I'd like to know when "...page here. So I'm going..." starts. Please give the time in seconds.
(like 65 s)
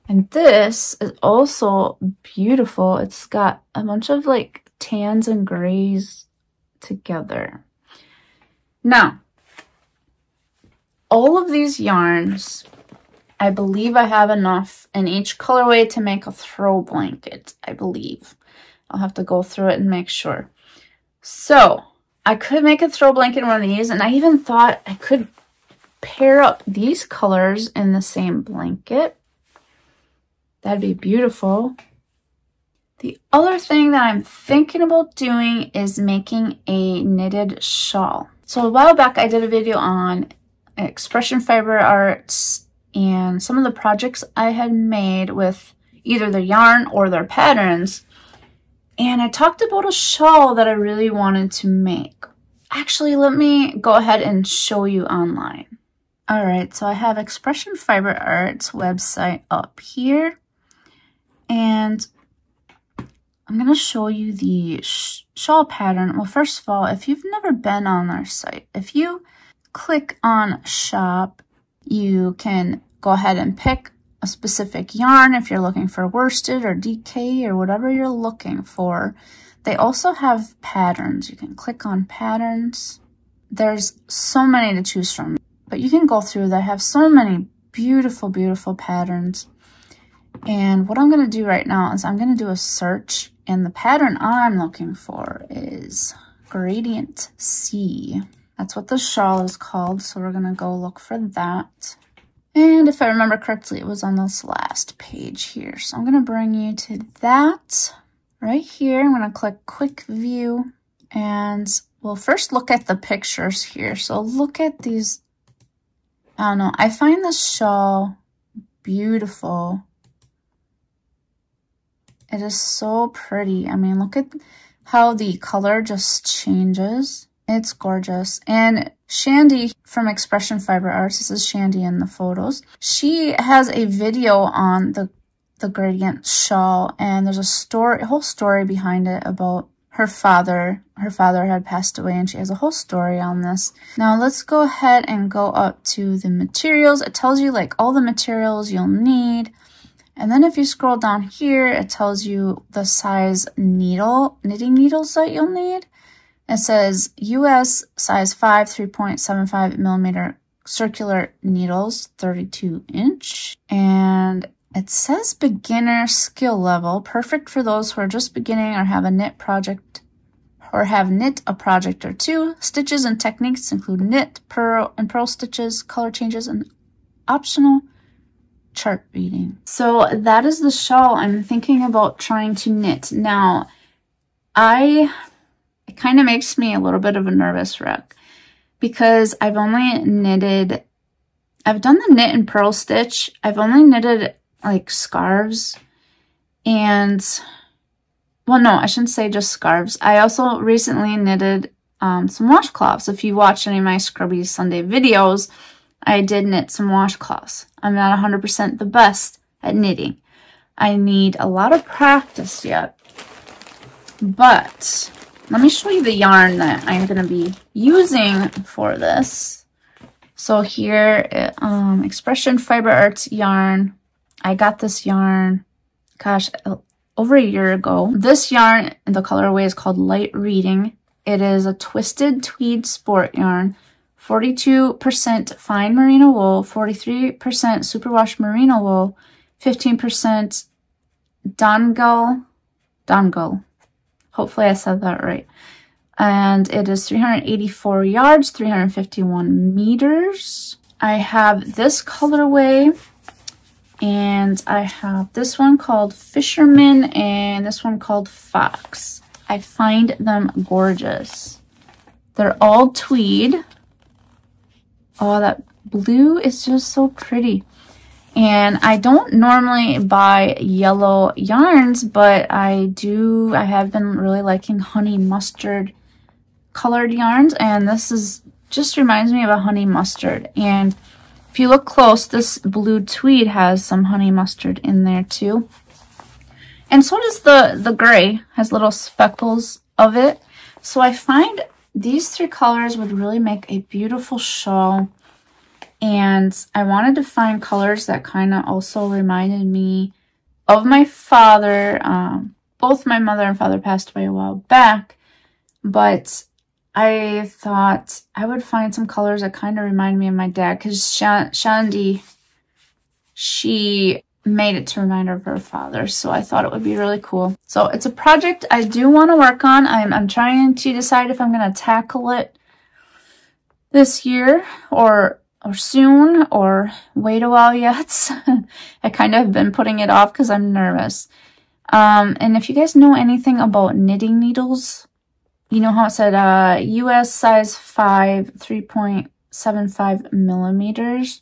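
104 s.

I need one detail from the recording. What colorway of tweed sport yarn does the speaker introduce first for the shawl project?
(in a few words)
Light Reading.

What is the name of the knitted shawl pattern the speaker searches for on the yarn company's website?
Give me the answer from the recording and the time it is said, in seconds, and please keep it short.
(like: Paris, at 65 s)
Gradient Sea, at 96 s.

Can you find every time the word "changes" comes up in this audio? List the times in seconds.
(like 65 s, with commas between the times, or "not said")
126 s, 176 s.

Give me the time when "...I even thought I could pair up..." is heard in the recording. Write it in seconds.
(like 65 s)
24 s.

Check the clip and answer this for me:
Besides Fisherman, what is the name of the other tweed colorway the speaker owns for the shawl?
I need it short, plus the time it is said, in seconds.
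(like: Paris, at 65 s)
Fox, at 258 s.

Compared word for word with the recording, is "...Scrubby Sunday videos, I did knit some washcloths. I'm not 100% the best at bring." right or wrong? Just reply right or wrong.
wrong.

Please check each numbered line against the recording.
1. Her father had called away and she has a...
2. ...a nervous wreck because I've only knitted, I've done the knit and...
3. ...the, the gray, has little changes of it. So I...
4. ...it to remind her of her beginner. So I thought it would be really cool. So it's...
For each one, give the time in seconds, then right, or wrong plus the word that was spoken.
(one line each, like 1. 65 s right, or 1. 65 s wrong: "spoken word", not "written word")
1. 140 s wrong: "passed", not "called"
2. 187 s right
3. 287 s wrong: "speckles", not "changes"
4. 314 s wrong: "father", not "beginner".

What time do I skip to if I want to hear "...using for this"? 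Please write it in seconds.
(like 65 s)
217 s.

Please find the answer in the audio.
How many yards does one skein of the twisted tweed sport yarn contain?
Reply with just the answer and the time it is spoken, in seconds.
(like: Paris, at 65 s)
384 yards, at 247 s.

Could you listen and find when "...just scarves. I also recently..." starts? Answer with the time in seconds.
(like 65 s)
199 s.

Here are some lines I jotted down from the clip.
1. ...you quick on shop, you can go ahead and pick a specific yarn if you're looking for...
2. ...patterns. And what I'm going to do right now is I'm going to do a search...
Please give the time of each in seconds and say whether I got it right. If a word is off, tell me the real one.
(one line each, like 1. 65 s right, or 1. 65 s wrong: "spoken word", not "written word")
1. 68 s wrong: "click", not "quick"
2. 88 s right.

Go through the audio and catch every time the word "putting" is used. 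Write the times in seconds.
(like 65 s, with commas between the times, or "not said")
329 s.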